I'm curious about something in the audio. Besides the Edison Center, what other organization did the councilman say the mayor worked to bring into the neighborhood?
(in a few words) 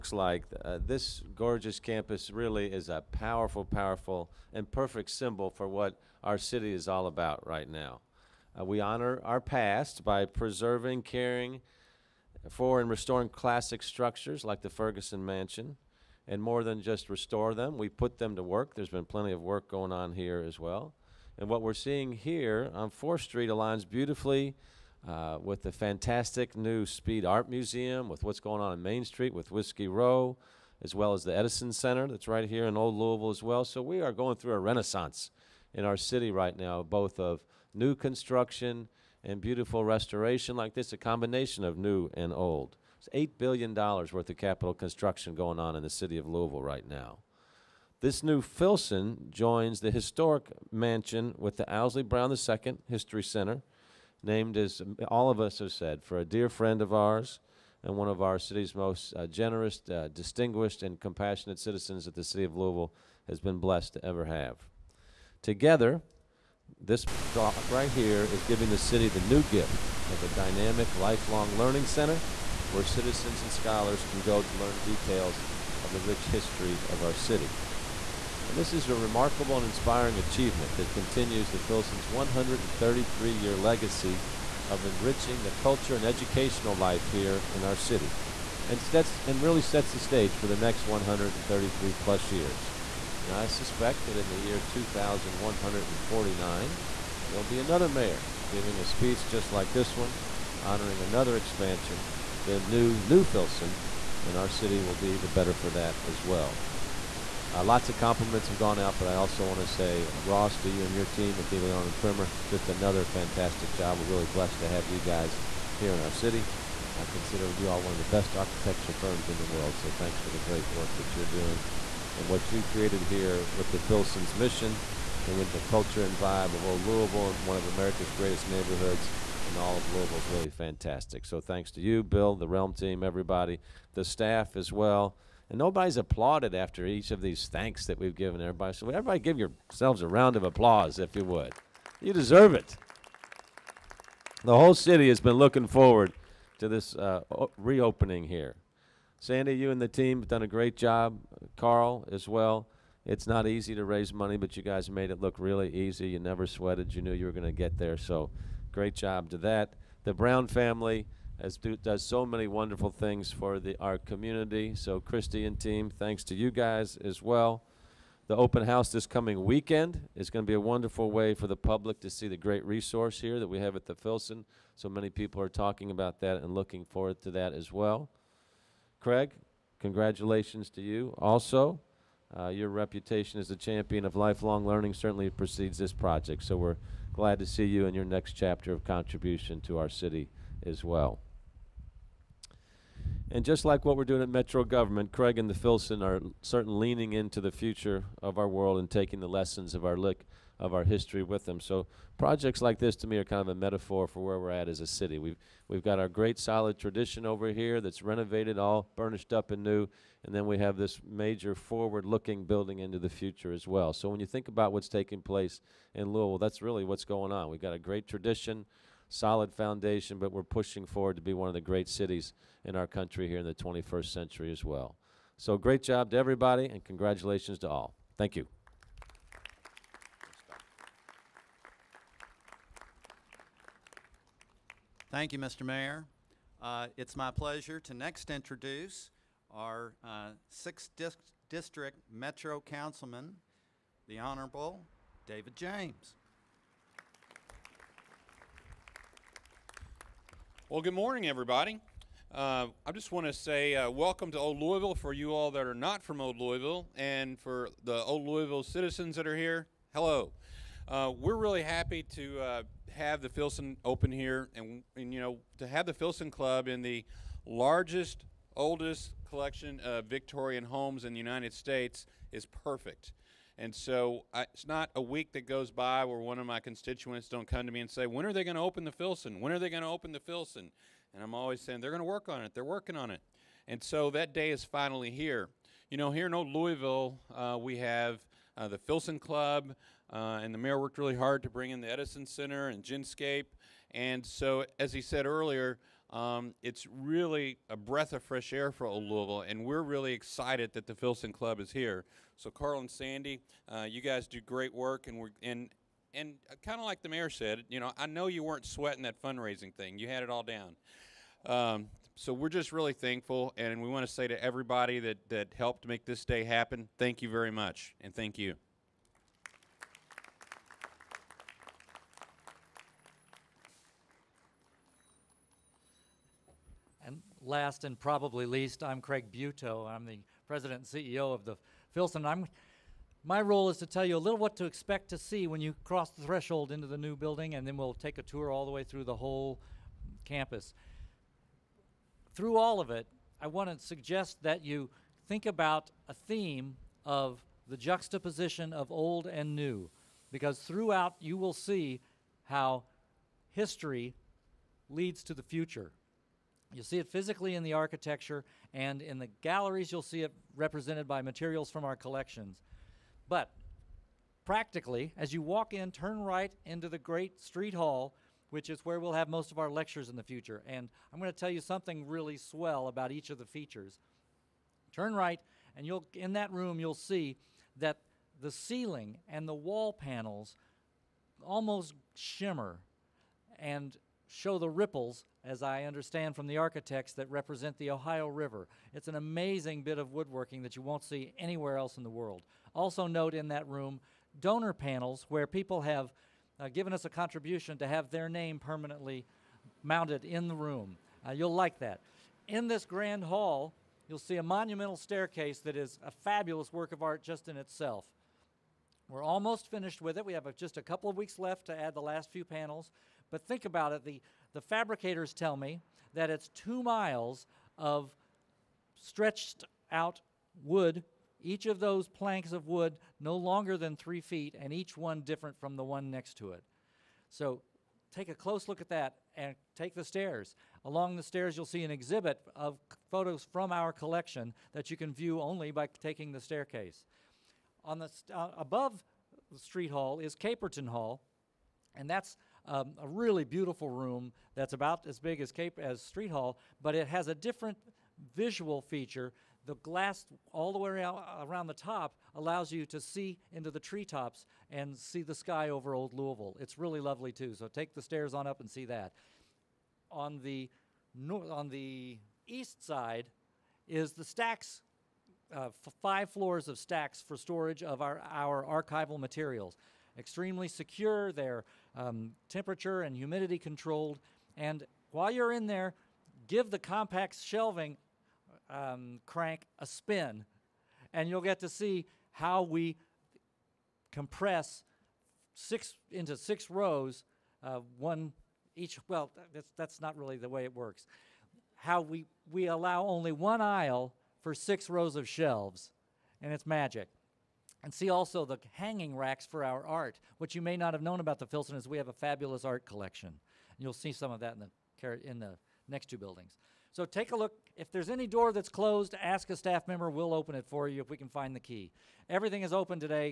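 Genscape.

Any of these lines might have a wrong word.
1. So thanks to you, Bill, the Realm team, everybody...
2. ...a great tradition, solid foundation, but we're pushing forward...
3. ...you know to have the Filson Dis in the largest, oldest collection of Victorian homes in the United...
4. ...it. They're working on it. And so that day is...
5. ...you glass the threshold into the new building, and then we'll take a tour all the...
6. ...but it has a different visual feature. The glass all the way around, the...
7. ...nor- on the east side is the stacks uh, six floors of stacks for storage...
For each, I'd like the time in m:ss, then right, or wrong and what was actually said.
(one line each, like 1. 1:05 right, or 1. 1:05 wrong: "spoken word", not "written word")
1. 2:11 right
2. 3:37 right
3. 4:25 wrong: "Club", not "Dis"
4. 4:42 right
5. 5:35 wrong: "cross", not "glass"
6. 7:26 right
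7. 7:41 wrong: "five", not "six".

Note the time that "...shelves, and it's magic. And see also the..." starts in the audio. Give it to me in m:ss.
8:15.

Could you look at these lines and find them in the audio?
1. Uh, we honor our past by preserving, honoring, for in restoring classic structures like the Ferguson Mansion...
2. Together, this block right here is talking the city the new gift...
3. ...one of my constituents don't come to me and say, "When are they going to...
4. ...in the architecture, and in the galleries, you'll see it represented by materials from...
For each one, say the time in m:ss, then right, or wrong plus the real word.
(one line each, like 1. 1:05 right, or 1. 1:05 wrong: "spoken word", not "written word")
1. 0:08 wrong: "caring", not "honoring"
2. 1:05 wrong: "giving", not "talking"
3. 4:36 right
4. 5:57 right.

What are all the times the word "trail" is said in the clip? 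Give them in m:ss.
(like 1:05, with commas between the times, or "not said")
not said.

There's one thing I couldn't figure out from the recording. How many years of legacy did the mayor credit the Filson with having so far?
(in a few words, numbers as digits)
133.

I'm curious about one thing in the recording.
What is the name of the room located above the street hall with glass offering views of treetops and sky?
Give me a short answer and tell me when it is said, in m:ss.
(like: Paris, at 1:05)
Caperton Hall, at 7:20.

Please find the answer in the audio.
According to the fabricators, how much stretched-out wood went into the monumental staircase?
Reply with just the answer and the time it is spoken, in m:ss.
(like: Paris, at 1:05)
two miles, at 6:56.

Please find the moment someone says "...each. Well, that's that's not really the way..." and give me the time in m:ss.
8:08.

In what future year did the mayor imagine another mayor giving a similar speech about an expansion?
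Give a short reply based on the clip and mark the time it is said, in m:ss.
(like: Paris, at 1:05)
2149, at 1:34.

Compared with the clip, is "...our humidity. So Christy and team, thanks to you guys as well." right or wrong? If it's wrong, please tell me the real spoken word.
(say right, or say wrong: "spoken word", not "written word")
wrong: "community", not "humidity".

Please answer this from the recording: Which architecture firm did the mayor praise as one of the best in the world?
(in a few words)
DeLeon and Primmer.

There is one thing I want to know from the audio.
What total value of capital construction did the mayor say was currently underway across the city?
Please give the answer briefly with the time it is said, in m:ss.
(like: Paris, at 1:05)
$8 billion, at 0:43.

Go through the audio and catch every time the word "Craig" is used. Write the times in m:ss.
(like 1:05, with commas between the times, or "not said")
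2:58, 3:15, 5:28.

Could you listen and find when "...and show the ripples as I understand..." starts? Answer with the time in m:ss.
6:23.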